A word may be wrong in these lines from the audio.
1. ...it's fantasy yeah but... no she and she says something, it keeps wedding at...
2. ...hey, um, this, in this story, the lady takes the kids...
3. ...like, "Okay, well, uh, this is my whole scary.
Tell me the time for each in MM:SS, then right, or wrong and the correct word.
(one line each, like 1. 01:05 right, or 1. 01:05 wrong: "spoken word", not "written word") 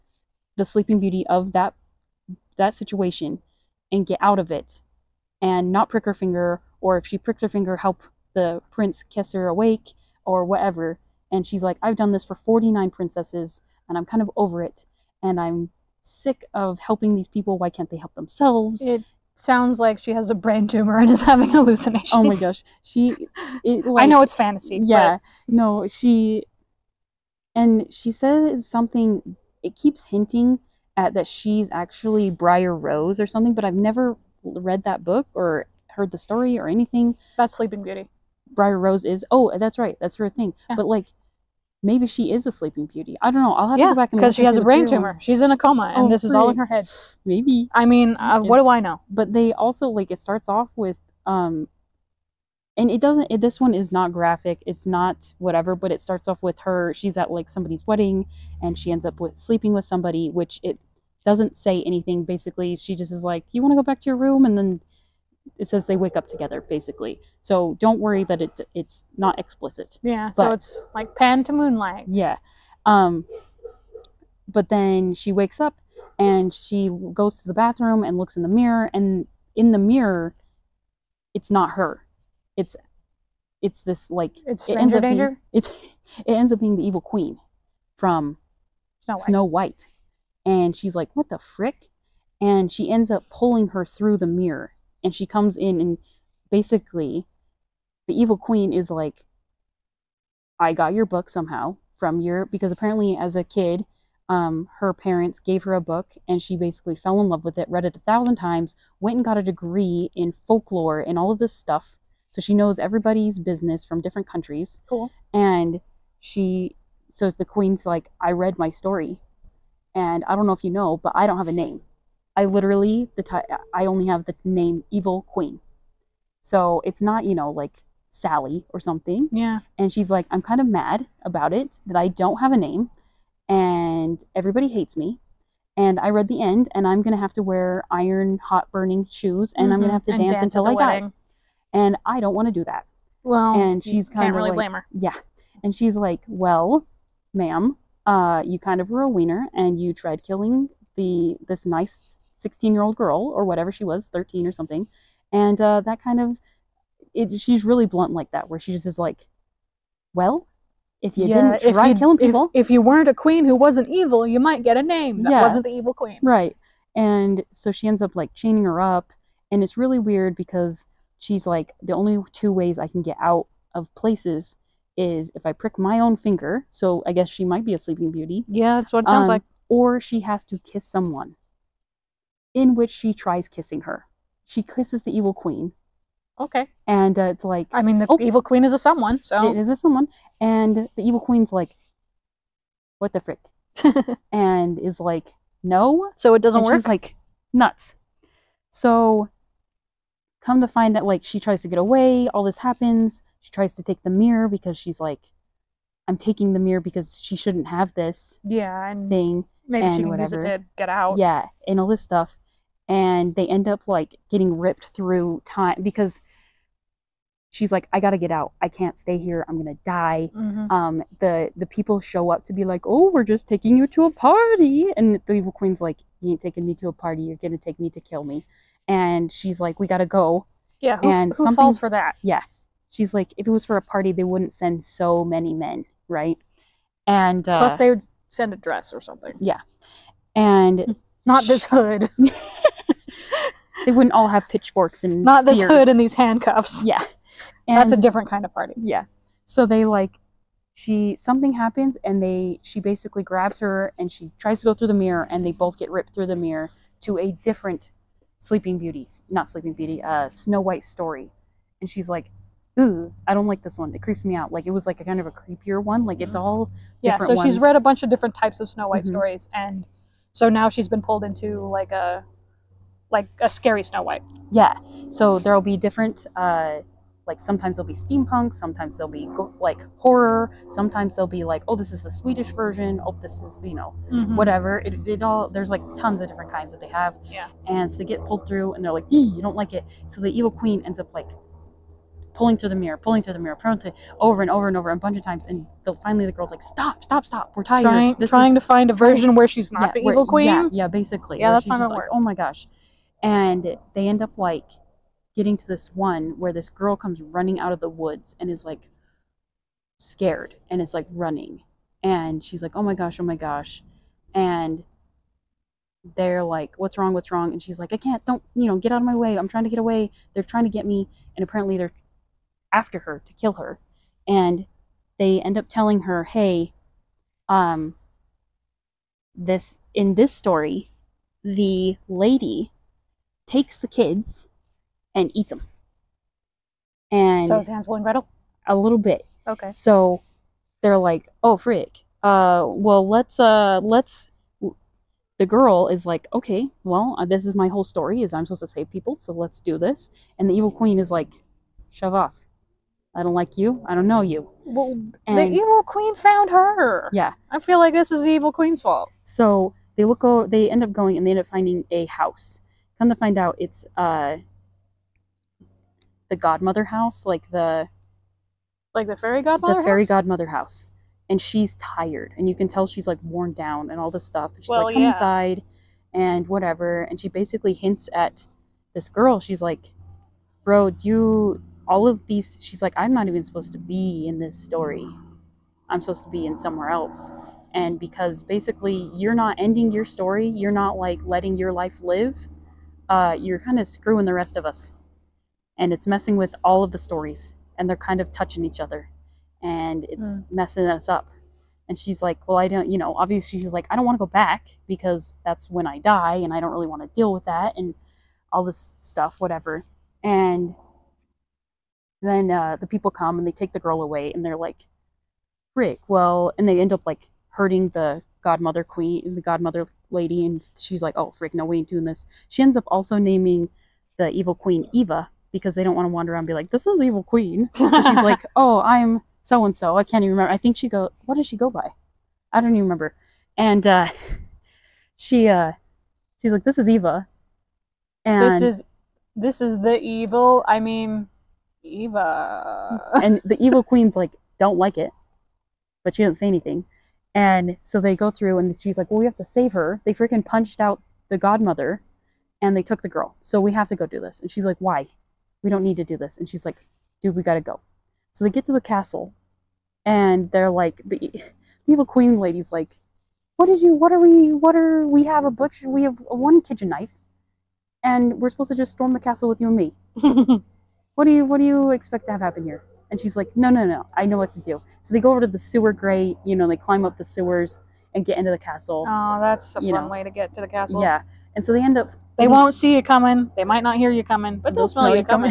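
1. 00:24 wrong: "hinting", not "wedding"
2. 05:26 right
3. 05:46 wrong: "story", not "scary".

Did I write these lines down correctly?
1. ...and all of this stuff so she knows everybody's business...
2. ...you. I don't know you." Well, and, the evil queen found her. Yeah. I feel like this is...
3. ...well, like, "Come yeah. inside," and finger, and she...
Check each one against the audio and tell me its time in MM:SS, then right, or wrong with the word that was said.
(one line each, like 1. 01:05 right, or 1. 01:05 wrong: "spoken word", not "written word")
1. 01:50 right
2. 05:53 right
3. 06:14 wrong: "whatever", not "finger".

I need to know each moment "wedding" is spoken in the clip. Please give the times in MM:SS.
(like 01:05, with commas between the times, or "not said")
00:57, 02:20.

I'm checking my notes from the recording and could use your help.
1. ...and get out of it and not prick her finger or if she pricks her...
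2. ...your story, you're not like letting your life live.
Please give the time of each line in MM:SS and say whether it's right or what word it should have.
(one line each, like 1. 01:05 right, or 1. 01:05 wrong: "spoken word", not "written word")
1. 00:03 right
2. 06:29 right.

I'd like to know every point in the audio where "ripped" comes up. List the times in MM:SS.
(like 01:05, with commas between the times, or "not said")
03:34, 04:15.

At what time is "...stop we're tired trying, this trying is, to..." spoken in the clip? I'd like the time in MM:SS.
04:57.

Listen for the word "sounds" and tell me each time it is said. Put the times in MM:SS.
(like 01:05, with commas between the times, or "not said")
00:19, 02:59.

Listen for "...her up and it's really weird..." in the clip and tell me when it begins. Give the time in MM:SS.
02:48.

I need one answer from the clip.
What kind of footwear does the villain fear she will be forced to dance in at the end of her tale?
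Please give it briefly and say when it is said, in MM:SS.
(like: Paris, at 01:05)
Iron hot burning shoes, at 02:17.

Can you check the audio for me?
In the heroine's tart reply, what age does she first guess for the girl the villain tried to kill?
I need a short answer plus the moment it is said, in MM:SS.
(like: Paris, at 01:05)
16, at 02:32.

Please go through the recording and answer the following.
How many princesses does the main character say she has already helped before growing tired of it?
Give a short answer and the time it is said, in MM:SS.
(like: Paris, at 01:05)
49, at 00:12.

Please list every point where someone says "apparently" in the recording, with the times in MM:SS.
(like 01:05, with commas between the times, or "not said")
01:42, 05:21.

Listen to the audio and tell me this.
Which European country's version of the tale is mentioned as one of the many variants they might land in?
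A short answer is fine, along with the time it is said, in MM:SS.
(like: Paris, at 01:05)
Swedish, at 04:42.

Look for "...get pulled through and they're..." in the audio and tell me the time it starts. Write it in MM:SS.
04:48.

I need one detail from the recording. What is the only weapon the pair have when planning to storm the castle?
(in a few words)
One kitchen knife.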